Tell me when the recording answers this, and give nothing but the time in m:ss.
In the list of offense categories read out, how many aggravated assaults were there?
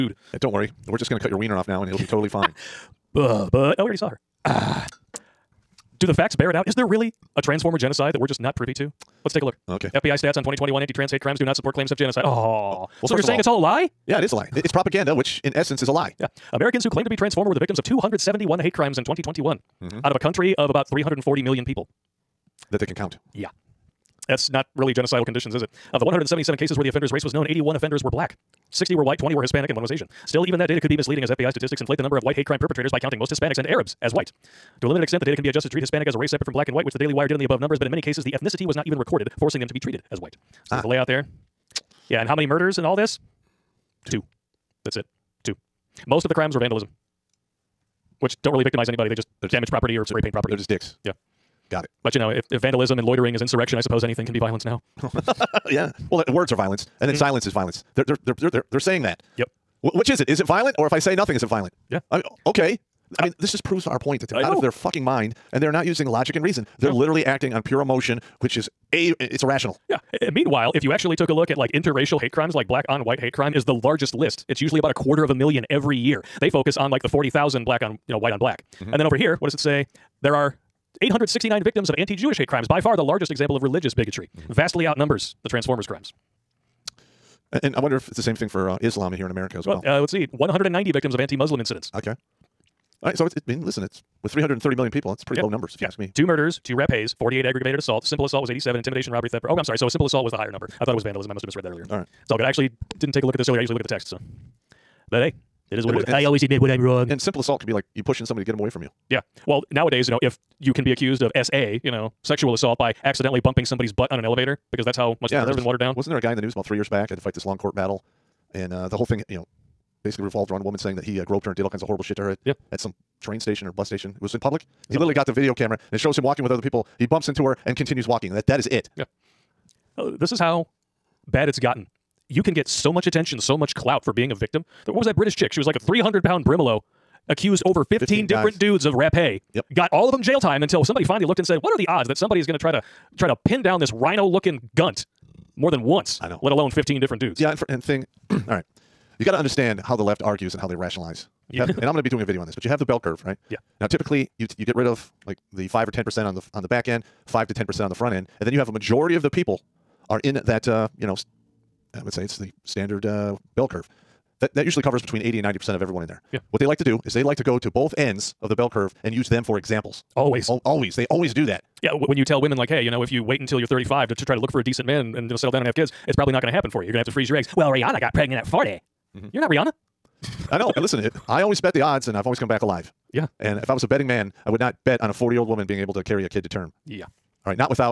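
1:37.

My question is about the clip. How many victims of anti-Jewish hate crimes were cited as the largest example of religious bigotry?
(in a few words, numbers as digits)
869.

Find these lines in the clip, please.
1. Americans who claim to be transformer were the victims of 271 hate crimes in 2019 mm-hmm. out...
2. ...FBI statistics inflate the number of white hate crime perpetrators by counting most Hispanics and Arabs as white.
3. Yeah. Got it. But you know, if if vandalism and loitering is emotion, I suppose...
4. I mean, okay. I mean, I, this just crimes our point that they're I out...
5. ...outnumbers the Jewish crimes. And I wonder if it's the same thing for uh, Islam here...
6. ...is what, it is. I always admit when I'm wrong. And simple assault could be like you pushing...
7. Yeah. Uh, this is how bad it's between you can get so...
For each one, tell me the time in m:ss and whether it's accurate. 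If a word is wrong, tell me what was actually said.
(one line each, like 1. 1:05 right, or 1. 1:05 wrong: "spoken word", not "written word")
1. 0:16 wrong: "2021", not "2019"
2. 0:31 right
3. 0:51 wrong: "insurrection", not "emotion"
4. 1:02 wrong: "proves", not "crimes"
5. 1:24 wrong: "Transformers", not "Jewish"
6. 1:45 right
7. 2:08 wrong: "gotten", not "between".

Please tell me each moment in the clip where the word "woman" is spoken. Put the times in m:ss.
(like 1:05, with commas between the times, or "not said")
2:00, 3:05.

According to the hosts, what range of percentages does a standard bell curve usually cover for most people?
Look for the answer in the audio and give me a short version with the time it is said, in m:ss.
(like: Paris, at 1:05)
80 to 90%, at 2:45.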